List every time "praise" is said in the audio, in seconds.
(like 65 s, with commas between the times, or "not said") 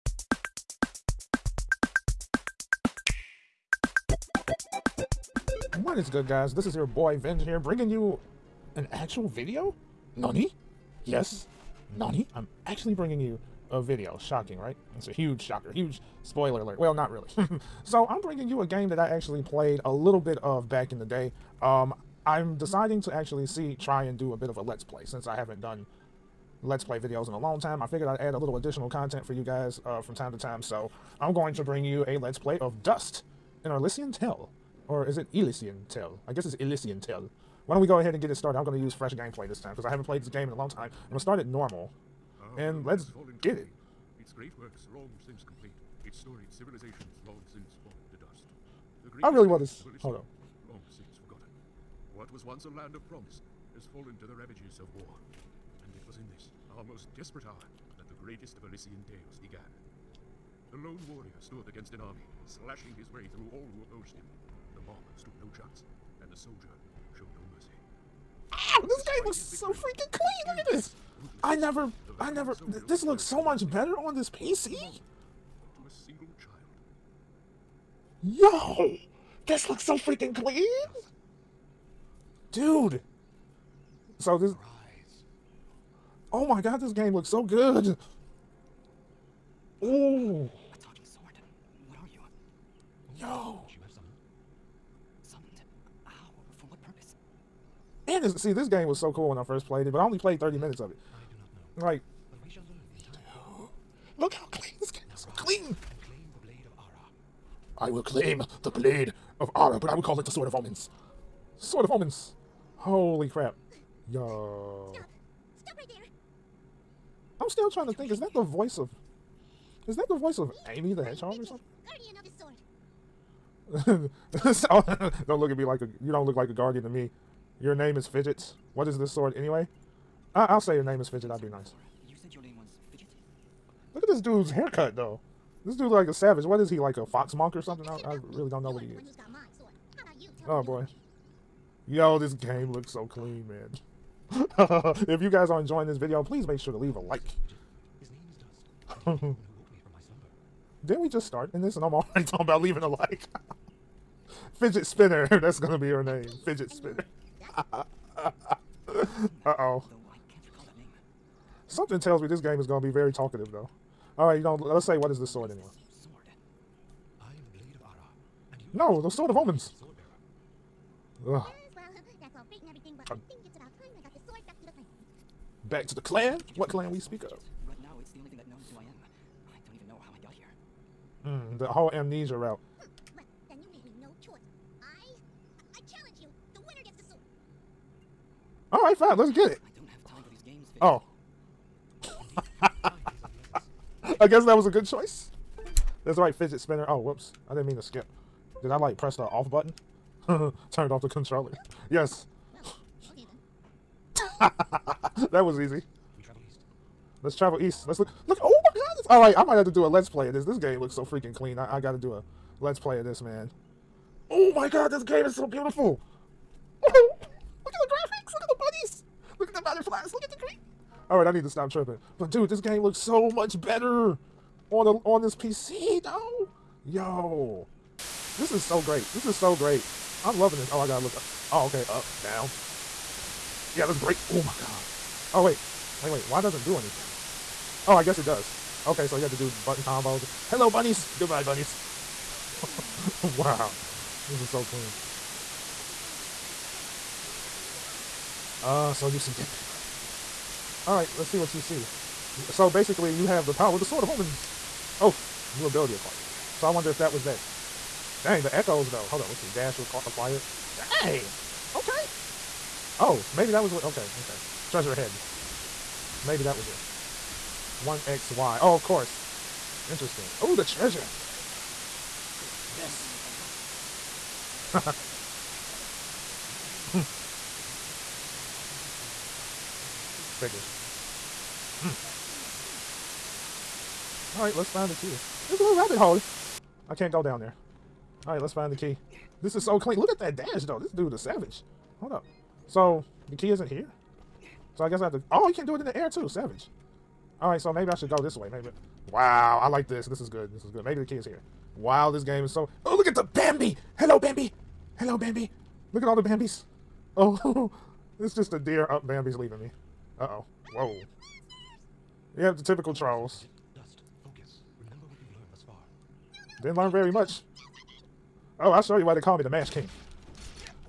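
not said.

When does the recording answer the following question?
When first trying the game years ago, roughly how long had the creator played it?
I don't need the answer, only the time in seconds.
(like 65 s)
100 s.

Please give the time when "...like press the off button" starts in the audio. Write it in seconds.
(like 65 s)
198 s.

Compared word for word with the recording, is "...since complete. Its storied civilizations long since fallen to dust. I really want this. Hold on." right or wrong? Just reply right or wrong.
right.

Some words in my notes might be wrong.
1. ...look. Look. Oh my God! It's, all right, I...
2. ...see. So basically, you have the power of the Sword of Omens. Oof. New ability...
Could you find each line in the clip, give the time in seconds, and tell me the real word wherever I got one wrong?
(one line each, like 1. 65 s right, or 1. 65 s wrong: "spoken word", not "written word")
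1. 207 s right
2. 251 s right.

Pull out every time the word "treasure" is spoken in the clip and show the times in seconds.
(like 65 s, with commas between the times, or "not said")
264 s, 270 s.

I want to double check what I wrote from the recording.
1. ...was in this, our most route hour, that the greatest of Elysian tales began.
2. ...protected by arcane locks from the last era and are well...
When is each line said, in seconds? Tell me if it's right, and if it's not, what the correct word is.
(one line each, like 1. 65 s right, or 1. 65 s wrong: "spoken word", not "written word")
1. 56 s wrong: "desperate", not "route"
2. 278 s right.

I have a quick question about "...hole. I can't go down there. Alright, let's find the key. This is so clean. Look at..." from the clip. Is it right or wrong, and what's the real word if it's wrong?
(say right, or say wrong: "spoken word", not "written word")
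right.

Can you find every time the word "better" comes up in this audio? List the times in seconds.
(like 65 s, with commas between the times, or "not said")
73 s, 223 s.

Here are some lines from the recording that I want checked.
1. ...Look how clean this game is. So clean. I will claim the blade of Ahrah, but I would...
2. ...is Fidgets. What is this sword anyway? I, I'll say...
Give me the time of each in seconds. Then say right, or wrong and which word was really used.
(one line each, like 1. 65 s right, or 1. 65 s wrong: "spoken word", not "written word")
1. 104 s right
2. 127 s right.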